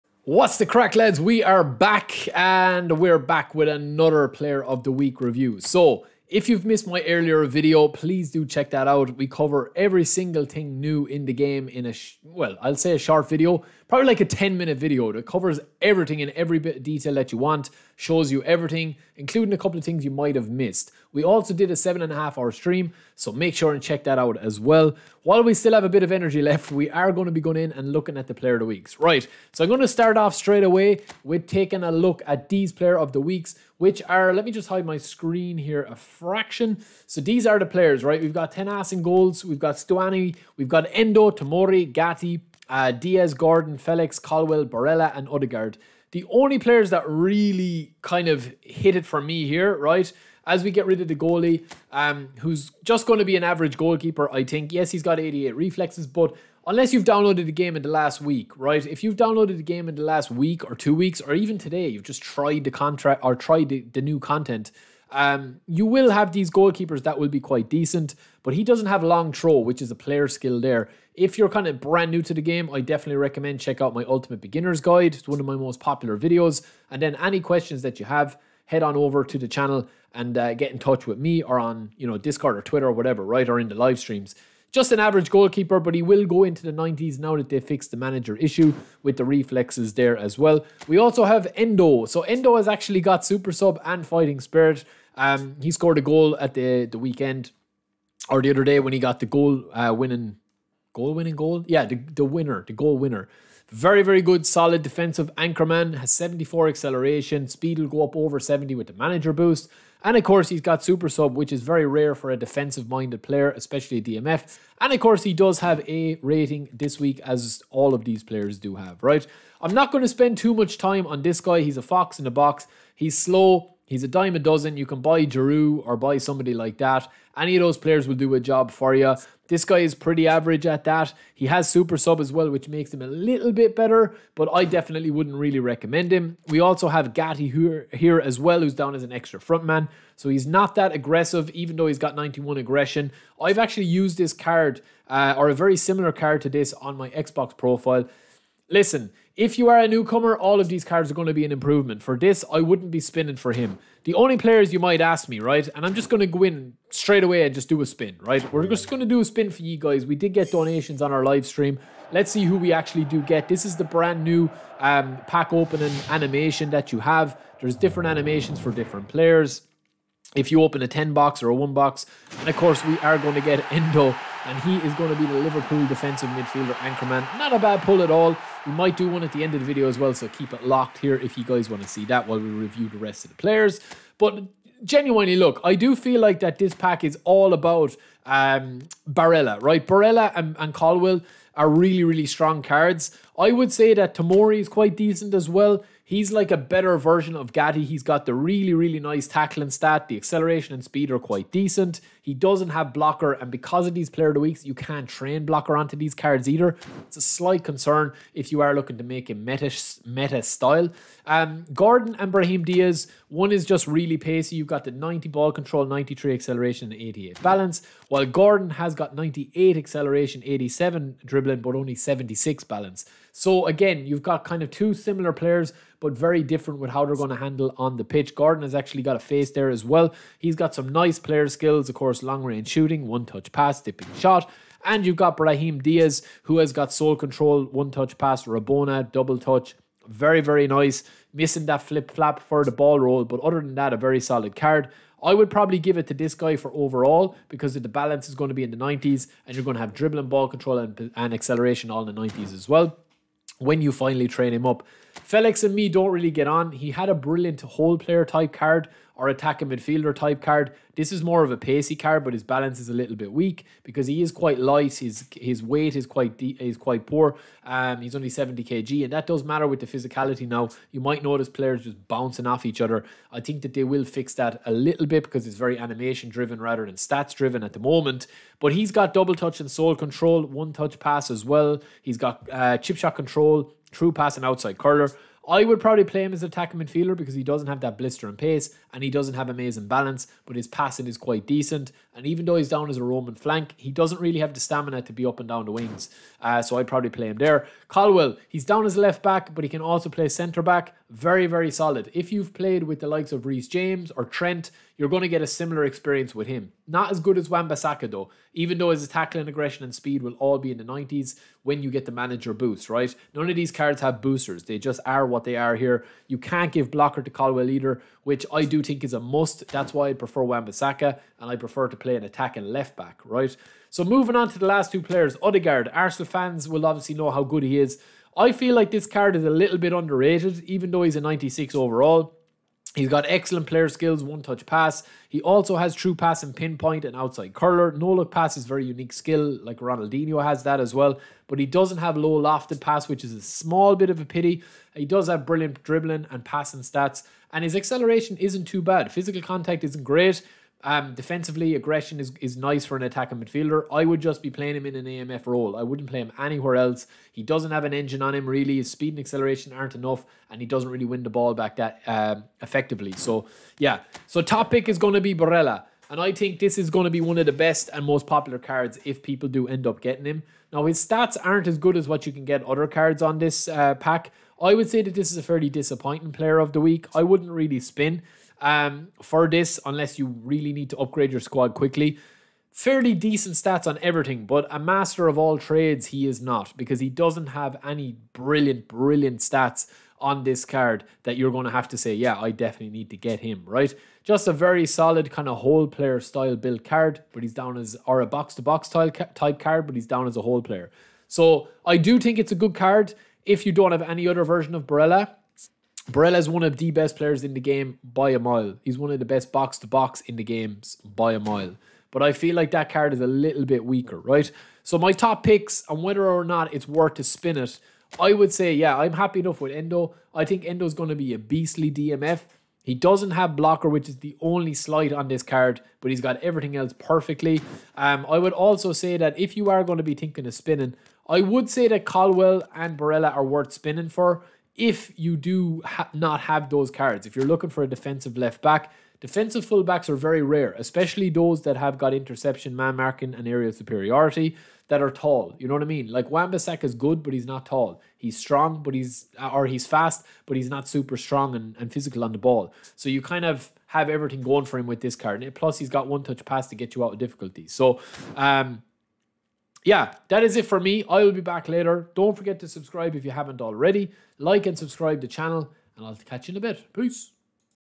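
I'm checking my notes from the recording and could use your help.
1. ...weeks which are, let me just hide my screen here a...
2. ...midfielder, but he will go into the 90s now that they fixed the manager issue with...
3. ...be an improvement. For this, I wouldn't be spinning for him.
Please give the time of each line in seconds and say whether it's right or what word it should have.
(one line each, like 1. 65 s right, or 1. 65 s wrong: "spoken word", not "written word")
1. 33 s right
2. 85 s wrong: "goalkeeper", not "midfielder"
3. 151 s right.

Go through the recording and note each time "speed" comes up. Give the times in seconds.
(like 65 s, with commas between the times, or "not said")
107 s, 200 s, 309 s, 358 s.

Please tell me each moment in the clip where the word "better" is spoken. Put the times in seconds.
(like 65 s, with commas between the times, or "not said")
133 s, 196 s.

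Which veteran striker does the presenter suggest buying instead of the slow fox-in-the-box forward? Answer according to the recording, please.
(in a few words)
Giroud.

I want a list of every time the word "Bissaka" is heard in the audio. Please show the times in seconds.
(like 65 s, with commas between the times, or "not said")
307 s, 320 s.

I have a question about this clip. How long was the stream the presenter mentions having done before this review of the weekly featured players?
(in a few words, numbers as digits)
7.5 hours.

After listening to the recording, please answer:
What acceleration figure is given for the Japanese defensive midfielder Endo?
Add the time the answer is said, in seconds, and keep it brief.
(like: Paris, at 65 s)
74, at 106 s.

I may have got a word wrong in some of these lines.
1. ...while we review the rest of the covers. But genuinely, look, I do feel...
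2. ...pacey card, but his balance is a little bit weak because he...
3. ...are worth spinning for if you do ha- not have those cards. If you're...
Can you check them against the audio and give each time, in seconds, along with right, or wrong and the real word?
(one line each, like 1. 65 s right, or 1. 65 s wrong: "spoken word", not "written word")
1. 182 s wrong: "players", not "covers"
2. 261 s right
3. 433 s right.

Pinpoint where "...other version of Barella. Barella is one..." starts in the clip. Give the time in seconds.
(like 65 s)
404 s.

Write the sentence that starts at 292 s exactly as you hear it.
And even though he's down as a roaming flank, he doesn't really have the stamina to be up and down the wings.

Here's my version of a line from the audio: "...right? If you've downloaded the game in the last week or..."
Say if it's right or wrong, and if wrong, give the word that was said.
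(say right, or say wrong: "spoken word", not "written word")
right.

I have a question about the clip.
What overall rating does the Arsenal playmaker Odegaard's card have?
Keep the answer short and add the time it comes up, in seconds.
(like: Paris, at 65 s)
96, at 331 s.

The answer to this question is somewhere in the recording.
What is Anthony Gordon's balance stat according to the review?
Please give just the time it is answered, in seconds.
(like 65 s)
221 s.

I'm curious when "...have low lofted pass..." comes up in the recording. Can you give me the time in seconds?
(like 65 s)
341 s.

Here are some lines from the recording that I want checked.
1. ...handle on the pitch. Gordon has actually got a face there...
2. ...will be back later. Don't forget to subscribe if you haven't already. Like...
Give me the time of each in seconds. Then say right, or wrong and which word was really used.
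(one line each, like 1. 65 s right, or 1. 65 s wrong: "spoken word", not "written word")
1. 227 s right
2. 461 s right.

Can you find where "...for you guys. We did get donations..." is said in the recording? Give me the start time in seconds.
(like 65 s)
159 s.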